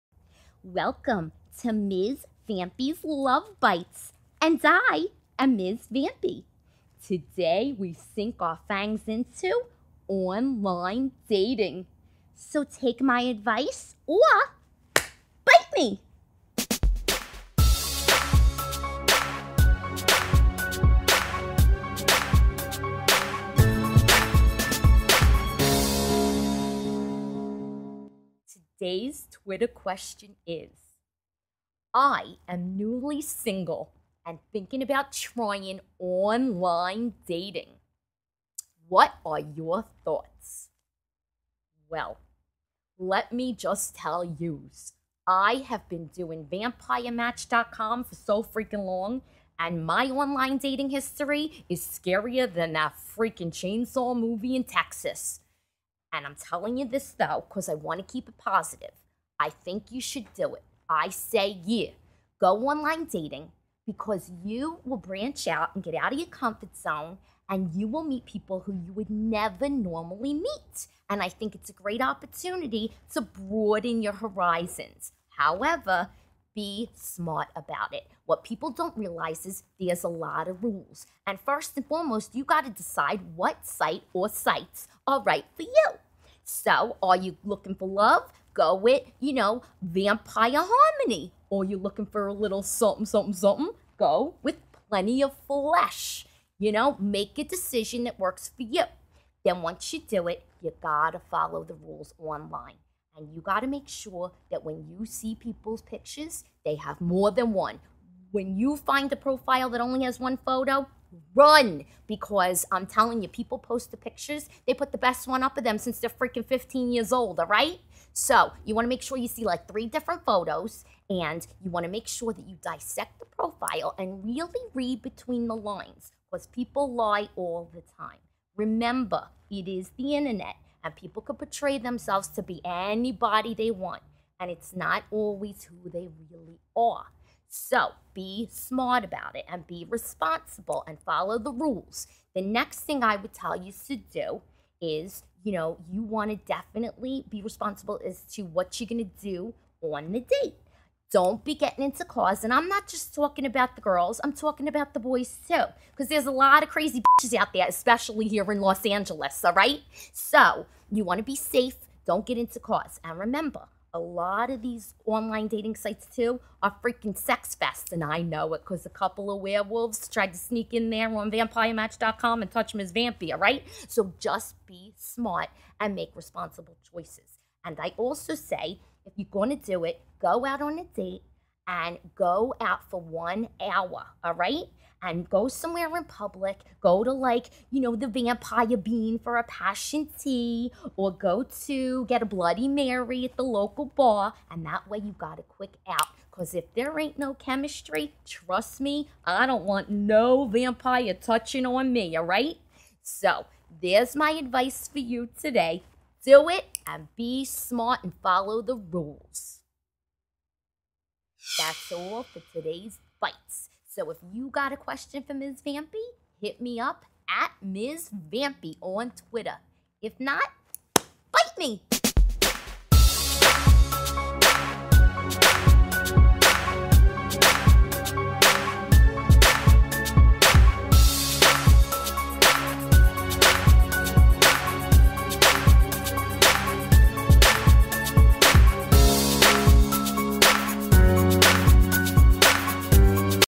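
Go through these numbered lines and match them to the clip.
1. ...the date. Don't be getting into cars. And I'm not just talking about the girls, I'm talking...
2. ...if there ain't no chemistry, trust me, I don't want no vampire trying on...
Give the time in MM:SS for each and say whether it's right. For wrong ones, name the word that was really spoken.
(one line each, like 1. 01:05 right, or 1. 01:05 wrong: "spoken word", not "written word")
1. 02:30 right
2. 03:16 wrong: "touching", not "trying".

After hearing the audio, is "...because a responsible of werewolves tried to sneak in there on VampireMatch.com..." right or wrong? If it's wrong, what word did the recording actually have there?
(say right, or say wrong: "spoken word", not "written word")
wrong: "couple", not "responsible".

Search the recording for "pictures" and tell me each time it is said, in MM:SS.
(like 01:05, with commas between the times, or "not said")
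01:45, 01:53.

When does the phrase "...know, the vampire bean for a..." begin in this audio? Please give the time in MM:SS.
03:07.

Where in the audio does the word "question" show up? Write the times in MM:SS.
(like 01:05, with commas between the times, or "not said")
00:29, 03:34.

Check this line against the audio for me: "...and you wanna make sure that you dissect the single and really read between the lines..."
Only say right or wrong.
wrong.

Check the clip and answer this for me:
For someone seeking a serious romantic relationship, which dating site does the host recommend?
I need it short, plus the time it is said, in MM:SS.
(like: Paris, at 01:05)
Vampire Harmony, at 01:29.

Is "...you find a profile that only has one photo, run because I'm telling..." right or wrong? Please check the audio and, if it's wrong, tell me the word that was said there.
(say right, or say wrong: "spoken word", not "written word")
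right.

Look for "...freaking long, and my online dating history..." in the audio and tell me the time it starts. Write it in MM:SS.
00:48.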